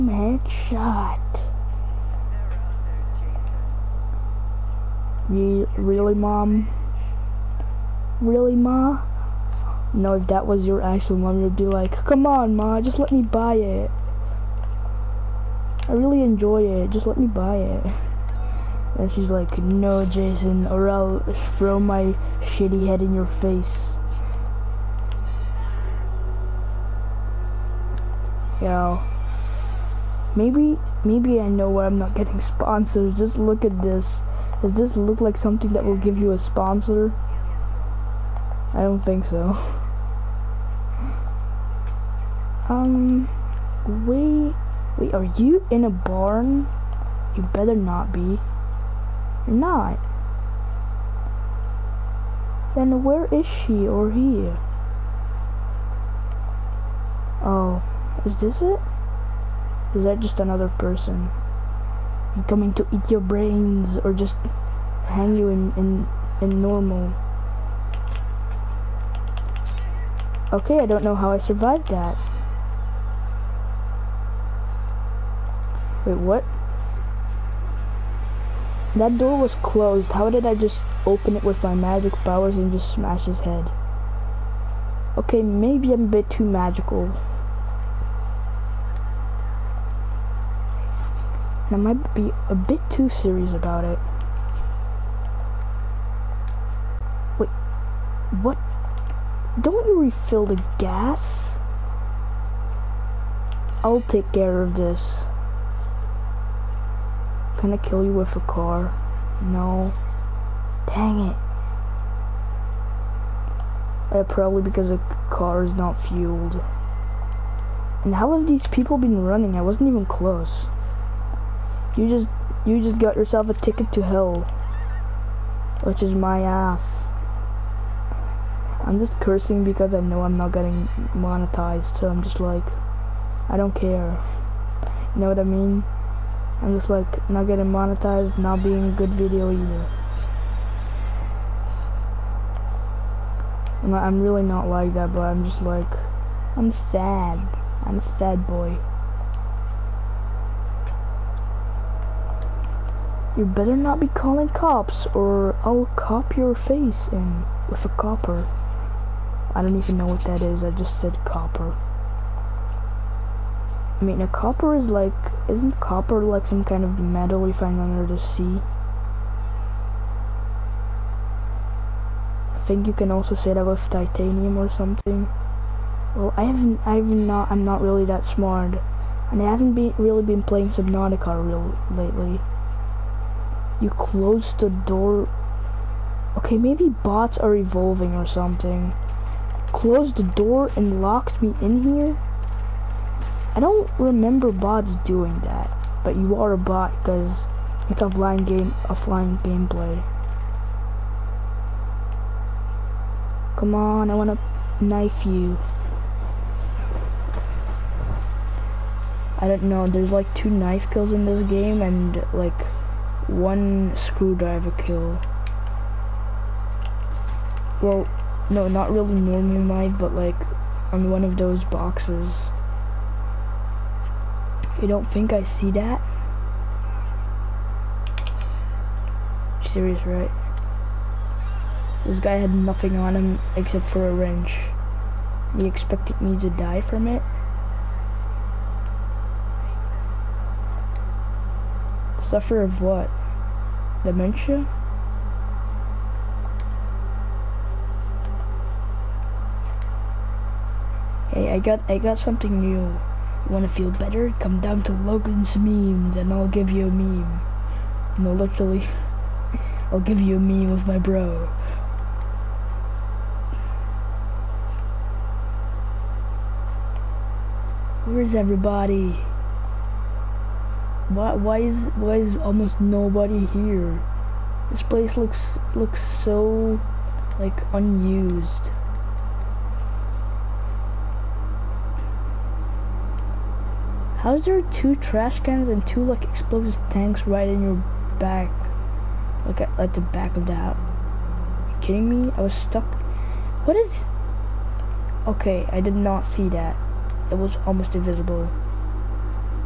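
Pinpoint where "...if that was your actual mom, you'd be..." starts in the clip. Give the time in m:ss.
0:10.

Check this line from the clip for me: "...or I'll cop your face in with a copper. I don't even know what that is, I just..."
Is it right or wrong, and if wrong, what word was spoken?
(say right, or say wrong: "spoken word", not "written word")
right.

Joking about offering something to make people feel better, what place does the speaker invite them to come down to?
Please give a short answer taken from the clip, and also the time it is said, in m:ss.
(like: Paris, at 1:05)
Logan's memes, at 4:14.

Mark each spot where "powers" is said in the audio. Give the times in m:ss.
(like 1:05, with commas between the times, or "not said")
1:22.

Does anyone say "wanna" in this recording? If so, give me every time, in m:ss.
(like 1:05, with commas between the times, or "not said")
3:24, 4:13.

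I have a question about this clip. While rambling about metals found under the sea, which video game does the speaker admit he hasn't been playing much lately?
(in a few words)
Subnautica.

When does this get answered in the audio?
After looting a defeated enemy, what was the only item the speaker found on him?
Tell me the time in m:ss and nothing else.
3:54.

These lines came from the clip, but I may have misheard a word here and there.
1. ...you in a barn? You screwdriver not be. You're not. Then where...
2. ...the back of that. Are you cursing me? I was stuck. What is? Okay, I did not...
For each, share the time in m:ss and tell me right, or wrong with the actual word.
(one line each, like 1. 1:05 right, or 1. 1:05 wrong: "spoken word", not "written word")
1. 0:45 wrong: "better", not "screwdriver"
2. 4:49 wrong: "kidding", not "cursing".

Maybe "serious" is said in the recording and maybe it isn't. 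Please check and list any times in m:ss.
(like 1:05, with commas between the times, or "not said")
1:33, 3:49.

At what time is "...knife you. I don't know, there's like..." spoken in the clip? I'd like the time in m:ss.
3:24.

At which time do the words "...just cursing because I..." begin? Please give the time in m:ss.
2:08.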